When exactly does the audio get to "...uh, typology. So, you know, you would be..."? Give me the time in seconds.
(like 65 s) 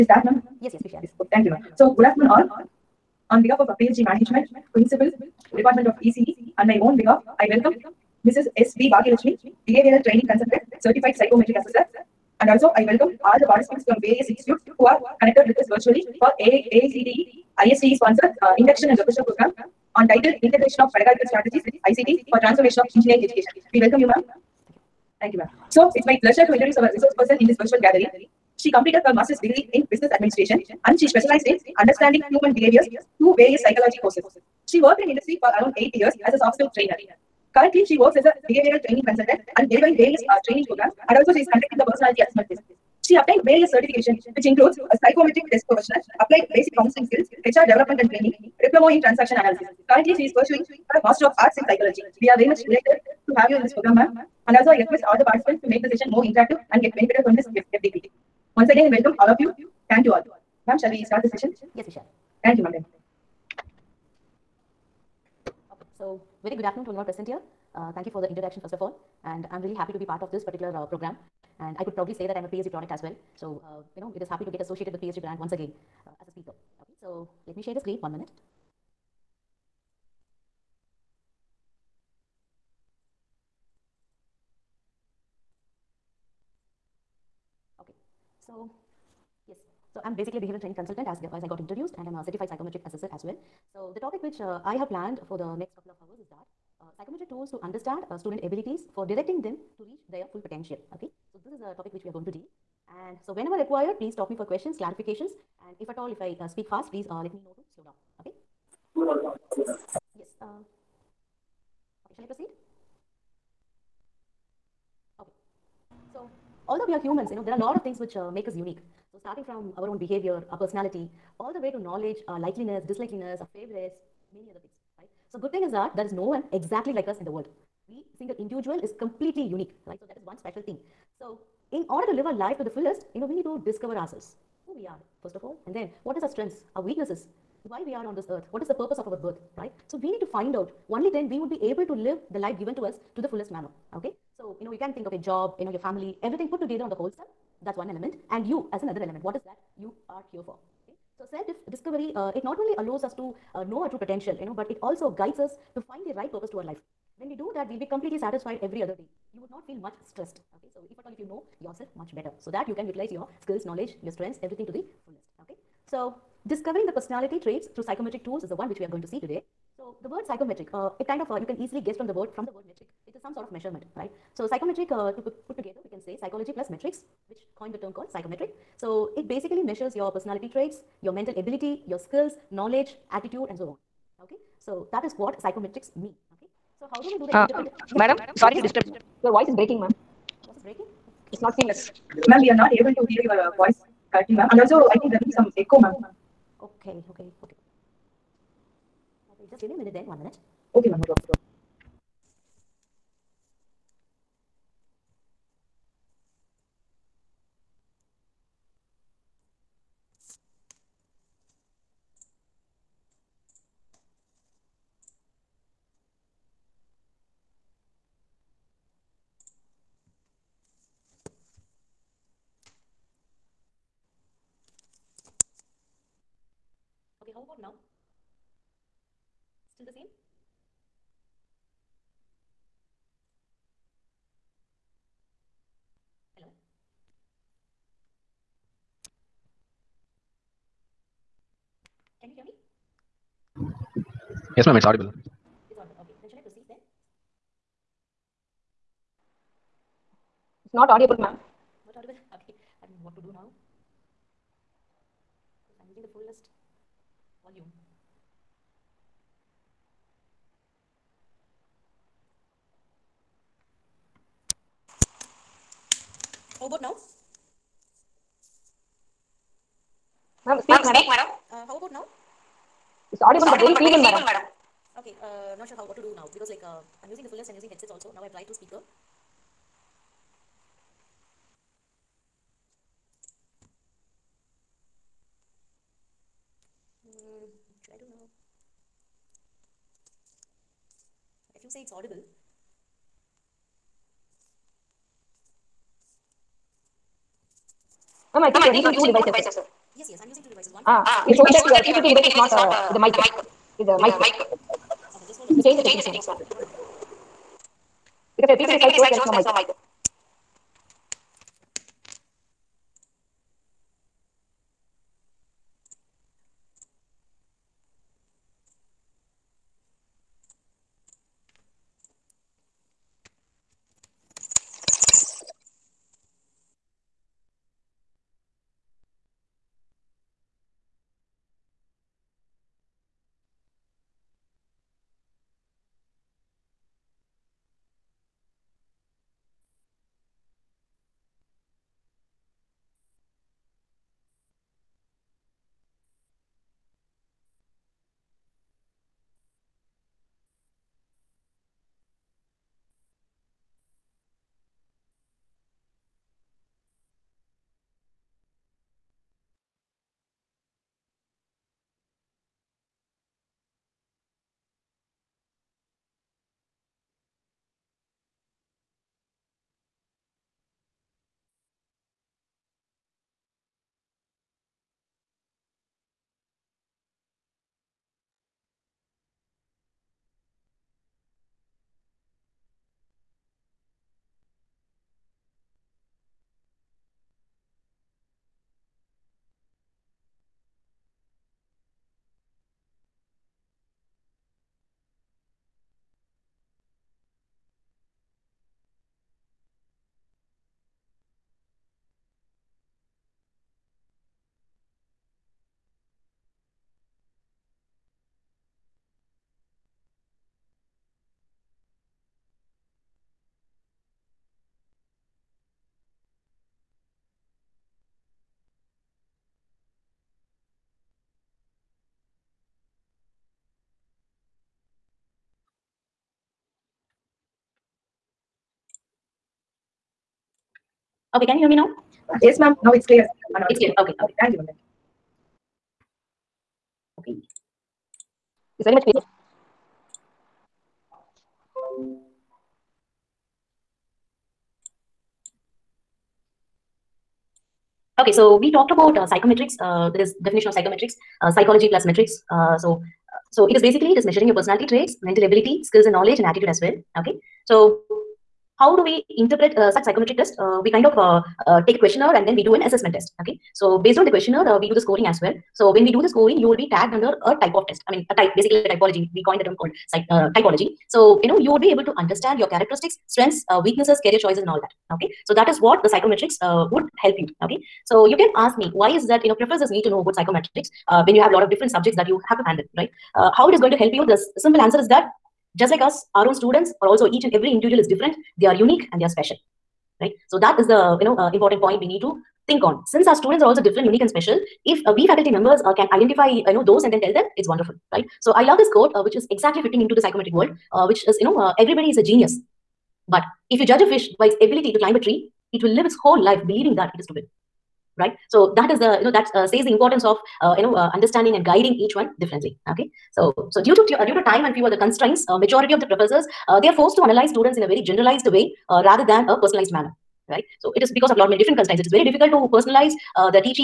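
470 s.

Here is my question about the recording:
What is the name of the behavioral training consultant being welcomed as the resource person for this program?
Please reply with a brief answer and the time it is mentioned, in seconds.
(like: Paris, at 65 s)
S. B. Bhagyalakshmi, at 8 s.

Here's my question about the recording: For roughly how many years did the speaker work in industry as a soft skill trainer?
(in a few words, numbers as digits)
8.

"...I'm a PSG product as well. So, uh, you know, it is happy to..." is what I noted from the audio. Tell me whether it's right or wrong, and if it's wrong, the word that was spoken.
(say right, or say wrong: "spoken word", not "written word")
right.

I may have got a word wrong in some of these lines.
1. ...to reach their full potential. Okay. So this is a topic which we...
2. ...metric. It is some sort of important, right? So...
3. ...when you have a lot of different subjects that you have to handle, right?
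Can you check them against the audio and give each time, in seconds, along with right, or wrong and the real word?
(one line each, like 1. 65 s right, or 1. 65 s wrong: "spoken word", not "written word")
1. 99 s right
2. 172 s wrong: "measurement", not "important"
3. 481 s right.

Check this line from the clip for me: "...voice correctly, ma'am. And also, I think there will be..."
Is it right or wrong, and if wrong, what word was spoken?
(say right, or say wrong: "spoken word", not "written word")
right.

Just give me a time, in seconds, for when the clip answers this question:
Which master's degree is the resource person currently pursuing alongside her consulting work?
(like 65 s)
51 s.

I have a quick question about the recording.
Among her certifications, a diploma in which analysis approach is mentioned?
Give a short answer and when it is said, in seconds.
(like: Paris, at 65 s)
Transaction analysis, at 49 s.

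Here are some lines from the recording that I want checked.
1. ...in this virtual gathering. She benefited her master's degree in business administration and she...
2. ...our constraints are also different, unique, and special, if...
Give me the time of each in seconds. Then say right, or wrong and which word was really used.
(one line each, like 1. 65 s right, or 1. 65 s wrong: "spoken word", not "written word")
1. 27 s wrong: "completed", not "benefited"
2. 493 s wrong: "students", not "constraints".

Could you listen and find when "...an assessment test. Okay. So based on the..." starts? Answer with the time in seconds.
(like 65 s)
462 s.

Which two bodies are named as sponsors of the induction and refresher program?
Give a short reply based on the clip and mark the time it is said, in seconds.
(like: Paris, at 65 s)
AICTE ISTE, at 16 s.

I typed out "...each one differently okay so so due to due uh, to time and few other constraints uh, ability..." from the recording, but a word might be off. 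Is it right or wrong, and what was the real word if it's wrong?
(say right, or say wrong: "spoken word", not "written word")
wrong: "majority", not "ability".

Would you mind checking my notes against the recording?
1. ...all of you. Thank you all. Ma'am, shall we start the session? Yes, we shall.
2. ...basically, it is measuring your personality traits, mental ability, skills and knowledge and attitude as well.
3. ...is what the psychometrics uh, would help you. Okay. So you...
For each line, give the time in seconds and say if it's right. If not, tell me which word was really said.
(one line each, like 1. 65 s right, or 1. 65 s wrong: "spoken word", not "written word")
1. 59 s right
2. 453 s right
3. 475 s right.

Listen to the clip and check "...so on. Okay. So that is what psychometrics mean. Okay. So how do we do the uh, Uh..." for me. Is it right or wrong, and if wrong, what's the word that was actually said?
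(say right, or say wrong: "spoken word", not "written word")
right.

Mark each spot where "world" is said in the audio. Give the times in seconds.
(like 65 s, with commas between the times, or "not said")
127 s, 500 s.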